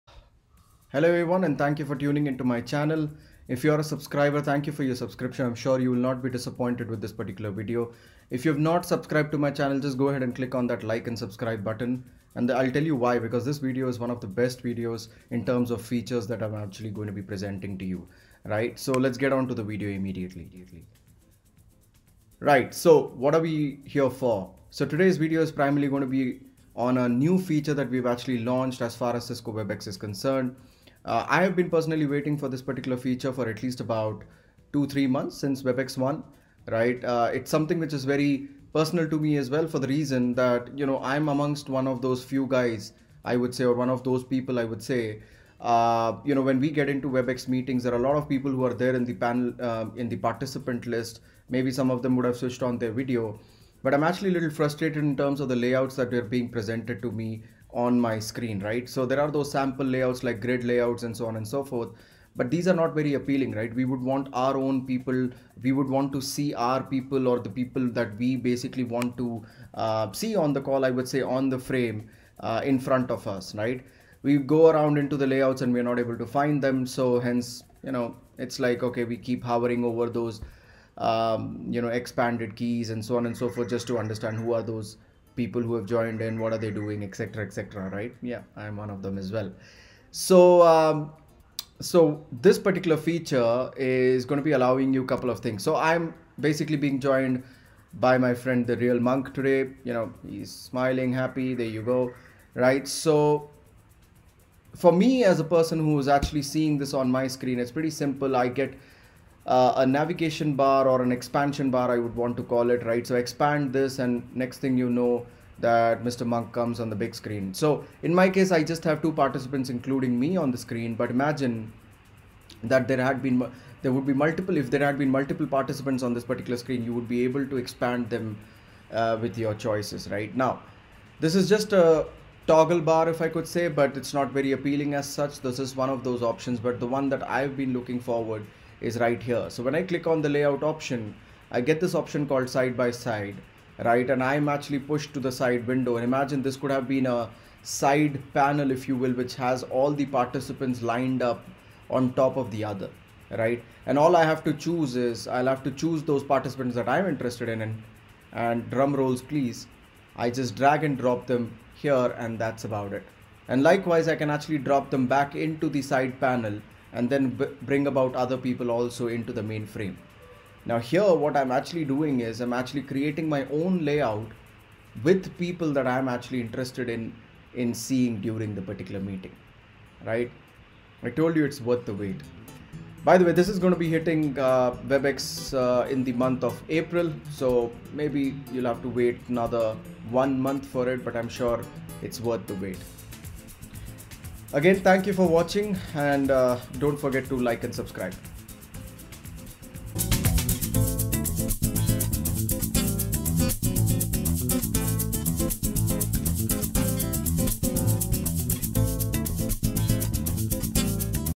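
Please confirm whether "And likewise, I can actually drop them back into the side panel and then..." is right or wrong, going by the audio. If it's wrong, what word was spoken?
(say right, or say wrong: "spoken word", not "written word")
right.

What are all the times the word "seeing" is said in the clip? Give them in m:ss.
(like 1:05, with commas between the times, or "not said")
1:46, 2:57.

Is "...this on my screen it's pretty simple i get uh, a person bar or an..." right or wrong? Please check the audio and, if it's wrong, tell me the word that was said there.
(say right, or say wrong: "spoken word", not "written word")
wrong: "navigation", not "person".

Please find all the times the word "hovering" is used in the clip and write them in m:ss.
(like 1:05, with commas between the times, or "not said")
1:19.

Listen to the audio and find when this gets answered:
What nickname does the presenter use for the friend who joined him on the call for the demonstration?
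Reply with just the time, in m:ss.
1:38.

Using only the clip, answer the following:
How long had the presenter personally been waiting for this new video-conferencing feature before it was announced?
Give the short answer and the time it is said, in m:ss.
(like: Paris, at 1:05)
2 to 3 months, at 0:34.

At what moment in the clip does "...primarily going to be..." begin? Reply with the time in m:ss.
0:25.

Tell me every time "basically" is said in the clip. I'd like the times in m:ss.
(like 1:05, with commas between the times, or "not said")
1:08, 1:36.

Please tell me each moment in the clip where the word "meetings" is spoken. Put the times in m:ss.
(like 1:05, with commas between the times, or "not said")
0:47, 2:58.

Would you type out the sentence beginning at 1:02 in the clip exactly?
But these are not very appealing, right?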